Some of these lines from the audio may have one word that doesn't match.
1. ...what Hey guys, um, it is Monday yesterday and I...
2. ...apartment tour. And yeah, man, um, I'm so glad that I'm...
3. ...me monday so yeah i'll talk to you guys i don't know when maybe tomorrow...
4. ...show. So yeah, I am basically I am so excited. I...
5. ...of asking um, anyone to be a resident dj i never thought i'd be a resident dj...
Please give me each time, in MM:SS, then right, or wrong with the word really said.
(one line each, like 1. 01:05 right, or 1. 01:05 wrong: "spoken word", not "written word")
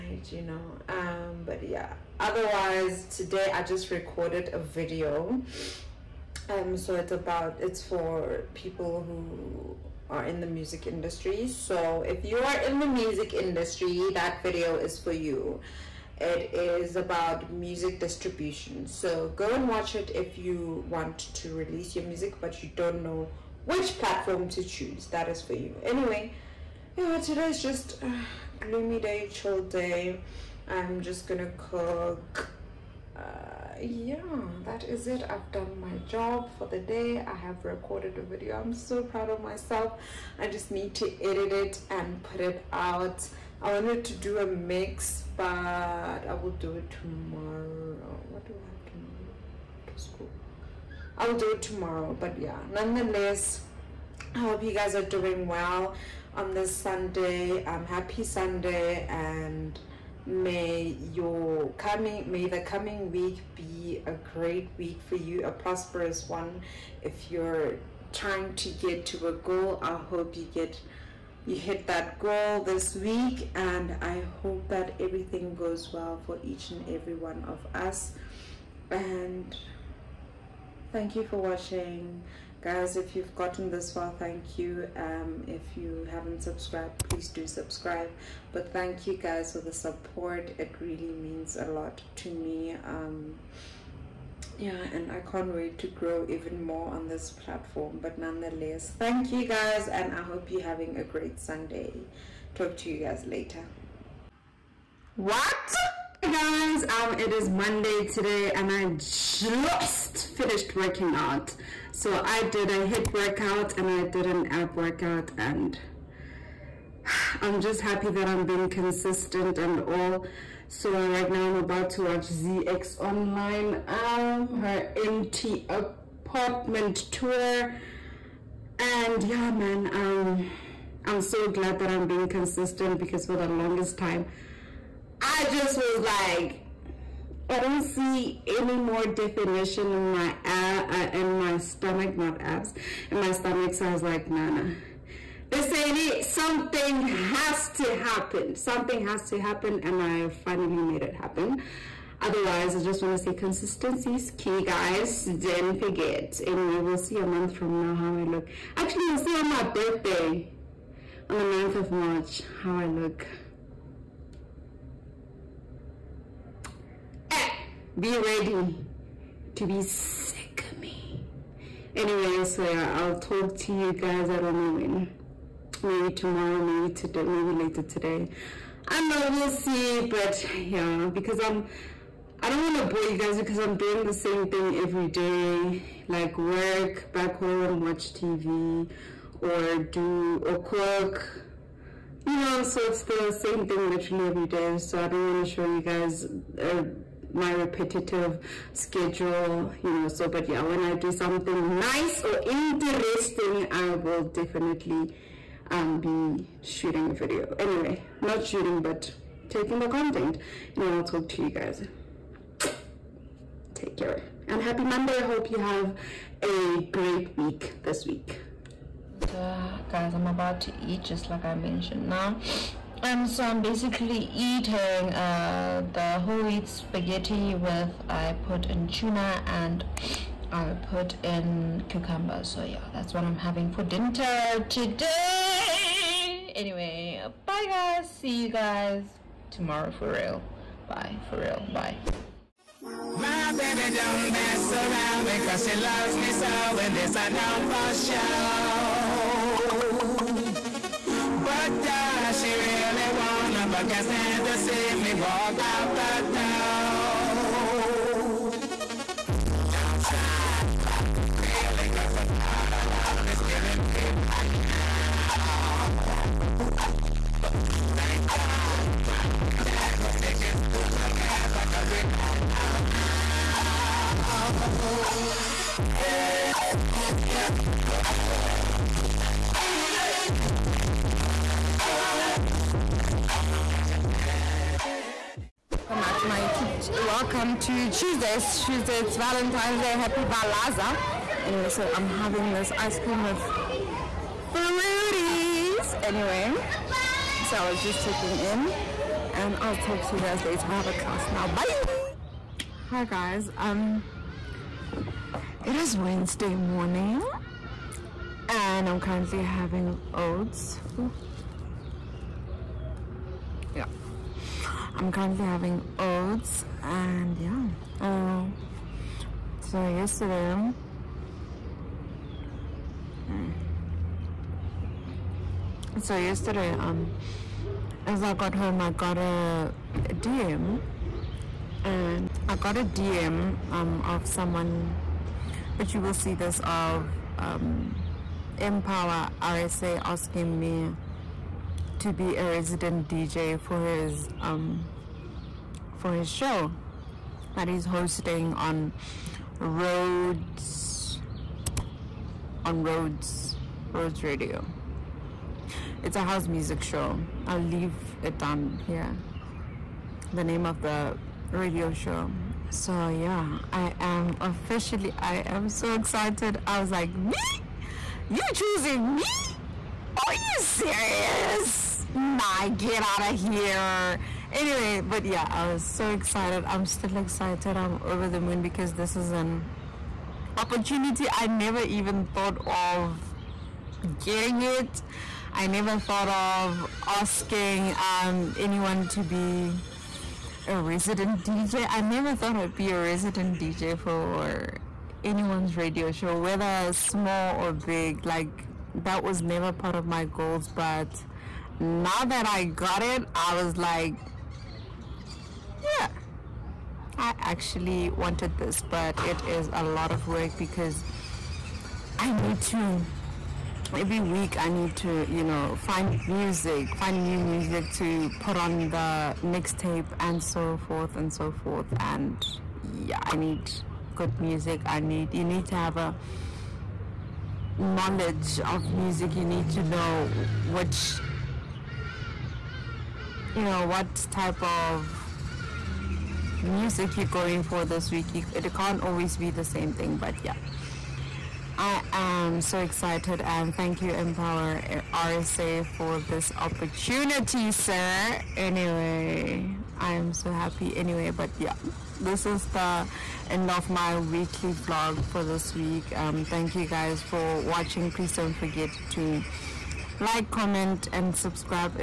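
1. 01:45 wrong: "today", not "yesterday"
2. 02:05 right
3. 02:50 wrong: "anyway", not "monday"
4. 06:01 wrong: "officially", not "basically"
5. 06:26 right.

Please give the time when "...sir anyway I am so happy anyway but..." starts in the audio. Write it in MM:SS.
07:27.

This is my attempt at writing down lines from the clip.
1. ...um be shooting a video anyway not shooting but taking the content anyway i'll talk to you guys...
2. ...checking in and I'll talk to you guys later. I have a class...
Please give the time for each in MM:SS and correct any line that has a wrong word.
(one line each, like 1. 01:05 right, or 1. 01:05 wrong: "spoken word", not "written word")
1. 03:25 right
2. 04:58 right.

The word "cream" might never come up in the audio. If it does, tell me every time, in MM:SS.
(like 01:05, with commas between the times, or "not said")
04:52.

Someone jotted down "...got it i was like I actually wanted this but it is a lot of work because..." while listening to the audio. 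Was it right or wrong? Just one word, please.
right.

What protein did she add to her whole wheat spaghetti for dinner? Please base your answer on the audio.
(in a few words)
Tuna.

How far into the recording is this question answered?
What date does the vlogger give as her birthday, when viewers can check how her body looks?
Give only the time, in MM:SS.
02:41.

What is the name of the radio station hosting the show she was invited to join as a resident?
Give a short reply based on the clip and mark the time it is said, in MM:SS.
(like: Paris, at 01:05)
Rhodes Radio, at 05:53.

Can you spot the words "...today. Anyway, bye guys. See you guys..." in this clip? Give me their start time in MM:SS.
03:54.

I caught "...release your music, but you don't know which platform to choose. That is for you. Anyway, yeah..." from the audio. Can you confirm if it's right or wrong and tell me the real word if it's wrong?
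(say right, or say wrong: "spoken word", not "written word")
right.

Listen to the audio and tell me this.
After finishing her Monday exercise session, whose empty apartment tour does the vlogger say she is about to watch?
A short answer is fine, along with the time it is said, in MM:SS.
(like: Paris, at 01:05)
ZX Online, at 02:02.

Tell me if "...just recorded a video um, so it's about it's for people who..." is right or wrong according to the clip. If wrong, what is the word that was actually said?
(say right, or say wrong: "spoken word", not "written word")
right.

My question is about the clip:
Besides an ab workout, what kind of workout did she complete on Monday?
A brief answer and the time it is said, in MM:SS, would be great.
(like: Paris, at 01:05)
HIIT, at 01:52.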